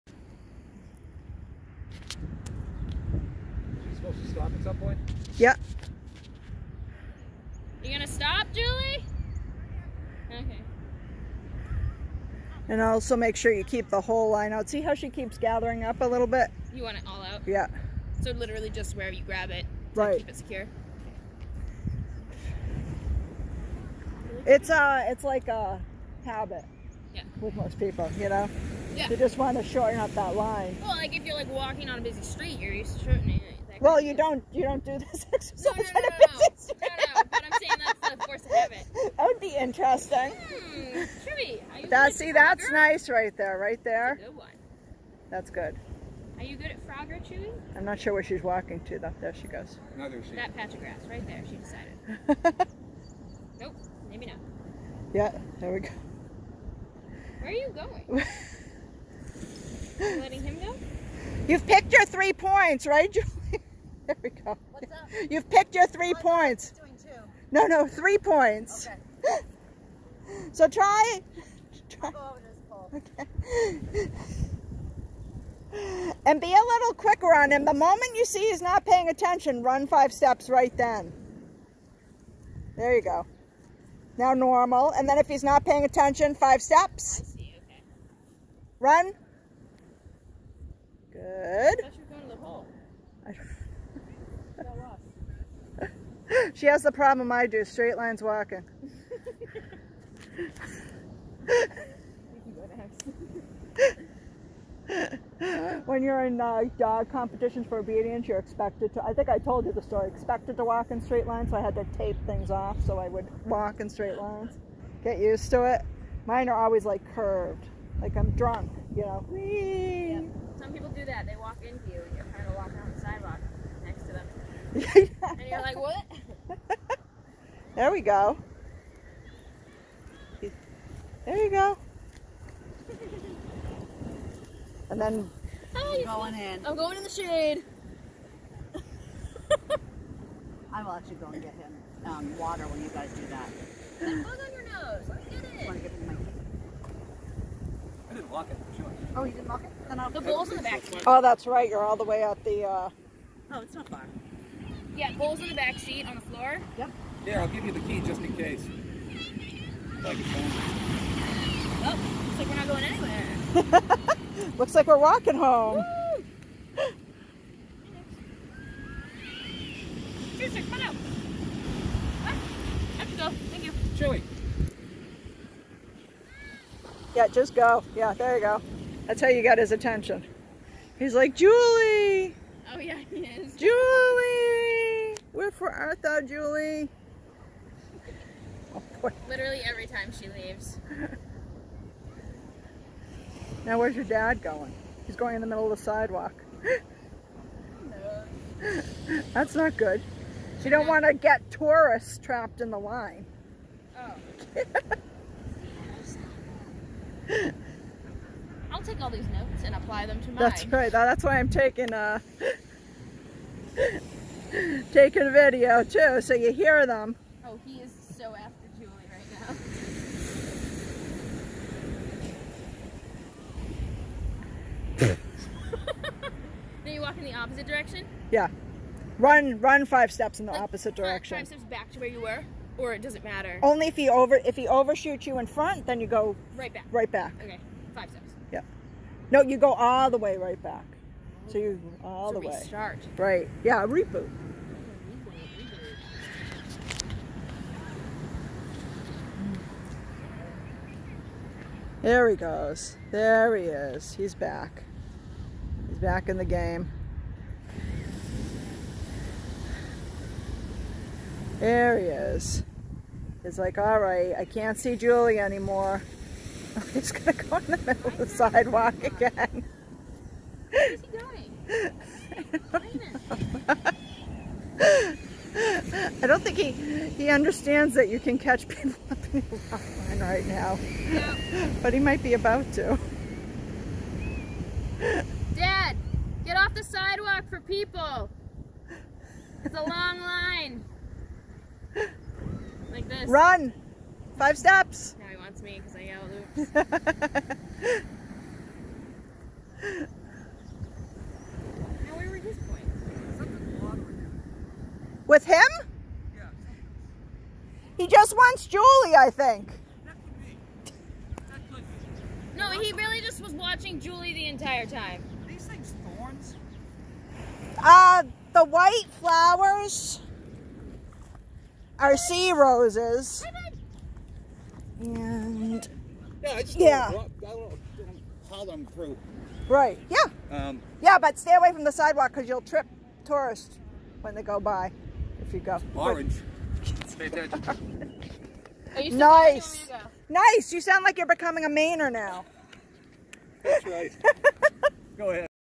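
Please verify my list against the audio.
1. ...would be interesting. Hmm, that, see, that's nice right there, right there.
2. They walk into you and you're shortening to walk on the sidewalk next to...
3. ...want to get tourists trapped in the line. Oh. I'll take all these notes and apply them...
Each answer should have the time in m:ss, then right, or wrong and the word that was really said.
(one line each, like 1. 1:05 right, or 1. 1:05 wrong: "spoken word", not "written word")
1. 0:39 right
2. 2:01 wrong: "trying", not "shortening"
3. 3:20 right.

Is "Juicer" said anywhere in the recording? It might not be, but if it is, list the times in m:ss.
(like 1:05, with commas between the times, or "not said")
2:50.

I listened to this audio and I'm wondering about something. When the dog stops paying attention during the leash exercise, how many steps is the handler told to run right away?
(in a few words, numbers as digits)
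5.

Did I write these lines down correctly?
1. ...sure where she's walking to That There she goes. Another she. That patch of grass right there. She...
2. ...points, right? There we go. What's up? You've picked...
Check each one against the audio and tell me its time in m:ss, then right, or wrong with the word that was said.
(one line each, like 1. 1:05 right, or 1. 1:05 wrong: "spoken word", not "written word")
1. 0:47 right
2. 1:02 right.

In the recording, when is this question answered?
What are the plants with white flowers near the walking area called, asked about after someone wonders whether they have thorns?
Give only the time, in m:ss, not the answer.
5:22.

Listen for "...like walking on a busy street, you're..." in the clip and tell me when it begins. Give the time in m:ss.
0:31.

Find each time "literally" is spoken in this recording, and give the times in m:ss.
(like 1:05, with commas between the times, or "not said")
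0:18, 3:09.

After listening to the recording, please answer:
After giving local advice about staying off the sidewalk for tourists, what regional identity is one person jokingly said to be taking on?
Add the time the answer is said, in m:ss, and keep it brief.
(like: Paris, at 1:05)
Mainer, at 5:41.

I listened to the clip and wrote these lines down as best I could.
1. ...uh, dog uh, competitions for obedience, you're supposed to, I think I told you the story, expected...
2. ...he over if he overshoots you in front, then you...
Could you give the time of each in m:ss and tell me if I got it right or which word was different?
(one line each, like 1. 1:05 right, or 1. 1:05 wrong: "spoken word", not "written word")
1. 1:46 wrong: "expected", not "supposed"
2. 3:53 right.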